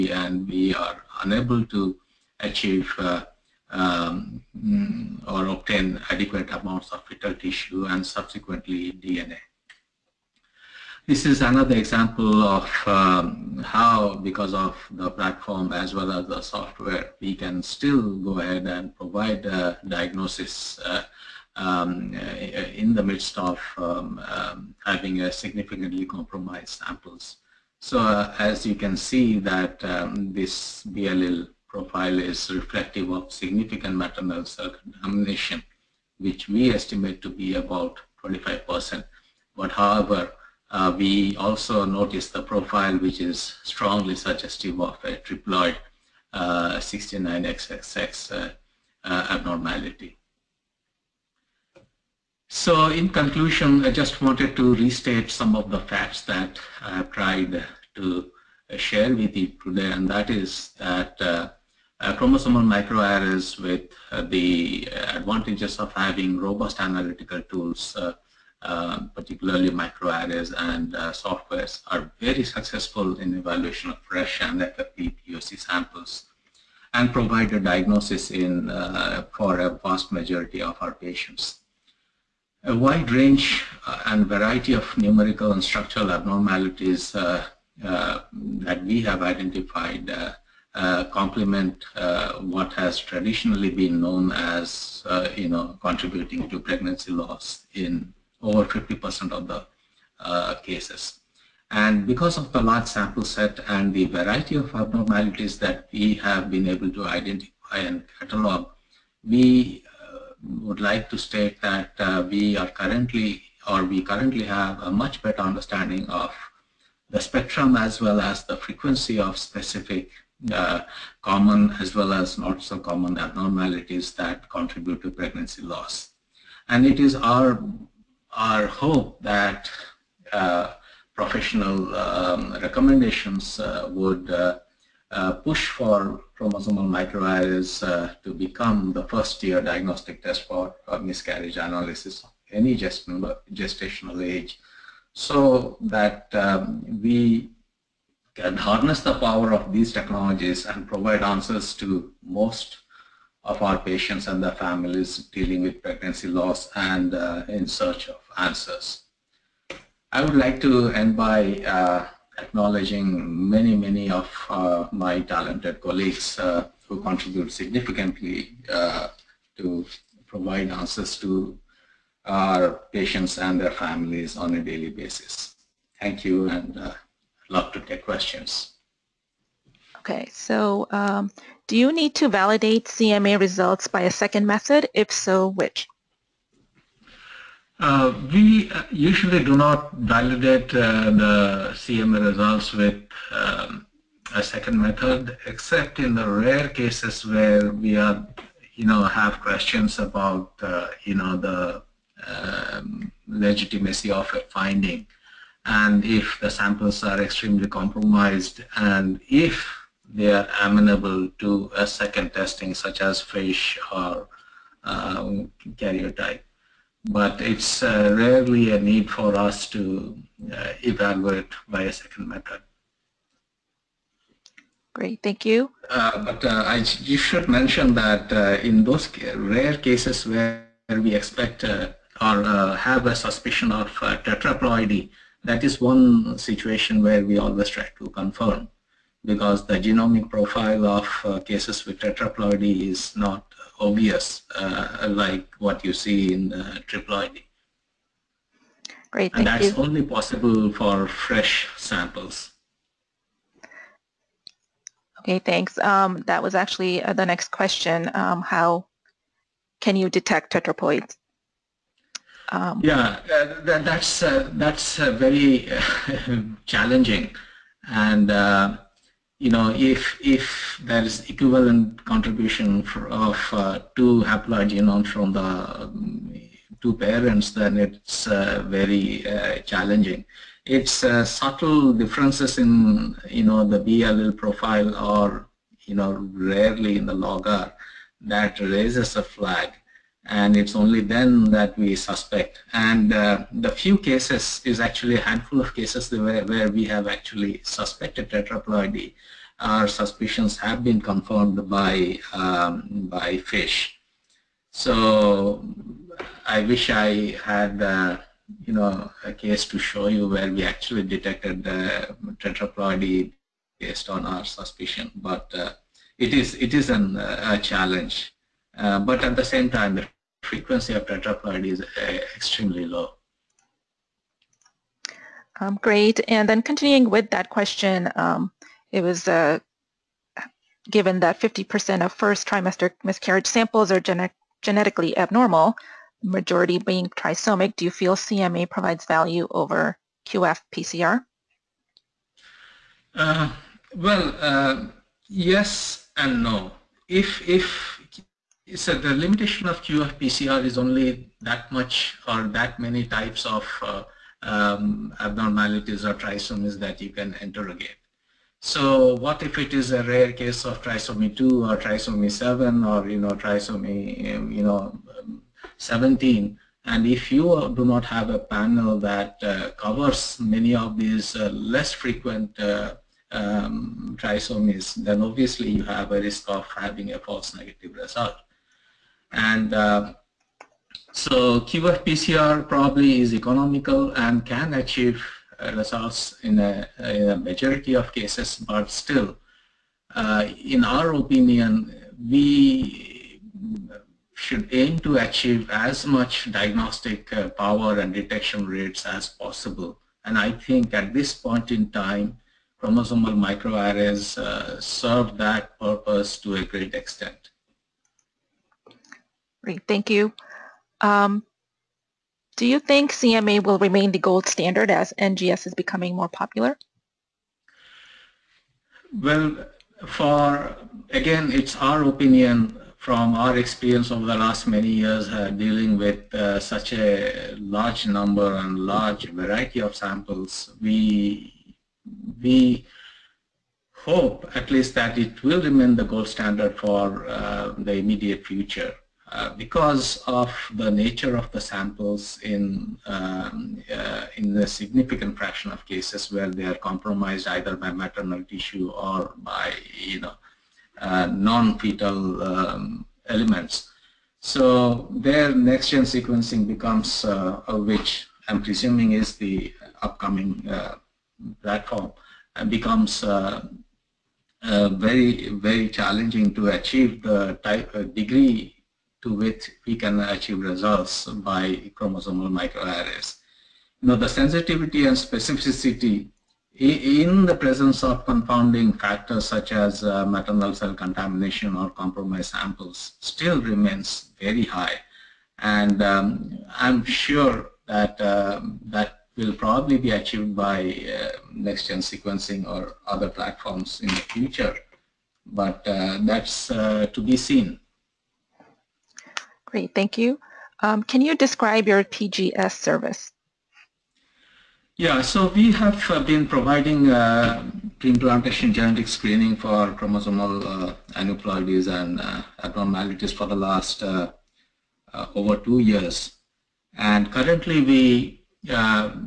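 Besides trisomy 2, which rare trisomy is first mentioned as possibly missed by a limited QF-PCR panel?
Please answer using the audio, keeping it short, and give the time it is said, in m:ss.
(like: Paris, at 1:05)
trisomy 7, at 6:01.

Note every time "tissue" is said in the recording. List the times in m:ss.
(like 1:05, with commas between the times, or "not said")
0:07, 7:28.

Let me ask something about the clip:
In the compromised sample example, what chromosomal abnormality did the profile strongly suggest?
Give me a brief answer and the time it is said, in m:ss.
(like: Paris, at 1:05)
69XXX, at 0:46.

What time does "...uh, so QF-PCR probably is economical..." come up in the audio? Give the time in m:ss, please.
6:19.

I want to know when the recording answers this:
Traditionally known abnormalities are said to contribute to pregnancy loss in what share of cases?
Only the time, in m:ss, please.
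1:38.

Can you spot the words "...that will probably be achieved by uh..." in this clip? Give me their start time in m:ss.
8:08.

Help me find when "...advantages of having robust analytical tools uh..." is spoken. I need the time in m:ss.
1:05.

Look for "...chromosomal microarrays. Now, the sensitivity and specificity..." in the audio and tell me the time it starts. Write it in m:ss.
7:51.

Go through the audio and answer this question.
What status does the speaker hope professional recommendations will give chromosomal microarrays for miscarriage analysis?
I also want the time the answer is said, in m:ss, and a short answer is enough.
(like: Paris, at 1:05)
first tier diagnostic test, at 2:19.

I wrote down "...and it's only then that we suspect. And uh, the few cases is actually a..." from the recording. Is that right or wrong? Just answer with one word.
right.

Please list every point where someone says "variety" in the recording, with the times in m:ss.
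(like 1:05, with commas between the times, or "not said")
1:24, 1:44, 7:09.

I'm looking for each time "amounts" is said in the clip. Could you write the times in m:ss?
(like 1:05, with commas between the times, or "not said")
0:06.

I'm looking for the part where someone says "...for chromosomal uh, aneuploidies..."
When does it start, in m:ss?
8:29.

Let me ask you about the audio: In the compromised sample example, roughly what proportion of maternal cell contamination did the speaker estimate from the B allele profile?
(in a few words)
25%.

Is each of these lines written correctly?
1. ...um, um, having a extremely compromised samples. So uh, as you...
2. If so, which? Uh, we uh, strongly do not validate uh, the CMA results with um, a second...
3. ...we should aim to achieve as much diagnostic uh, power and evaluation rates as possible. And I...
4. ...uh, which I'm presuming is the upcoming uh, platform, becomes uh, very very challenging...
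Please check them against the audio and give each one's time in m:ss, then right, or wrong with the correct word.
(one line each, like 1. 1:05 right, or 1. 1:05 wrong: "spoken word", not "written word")
1. 0:23 wrong: "significantly", not "extremely"
2. 3:04 wrong: "usually", not "strongly"
3. 6:32 wrong: "detection", not "evaluation"
4. 7:37 right.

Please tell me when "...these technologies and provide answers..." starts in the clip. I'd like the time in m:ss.
2:29.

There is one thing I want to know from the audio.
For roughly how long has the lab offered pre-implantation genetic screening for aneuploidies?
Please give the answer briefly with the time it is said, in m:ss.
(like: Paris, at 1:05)
over two years, at 8:35.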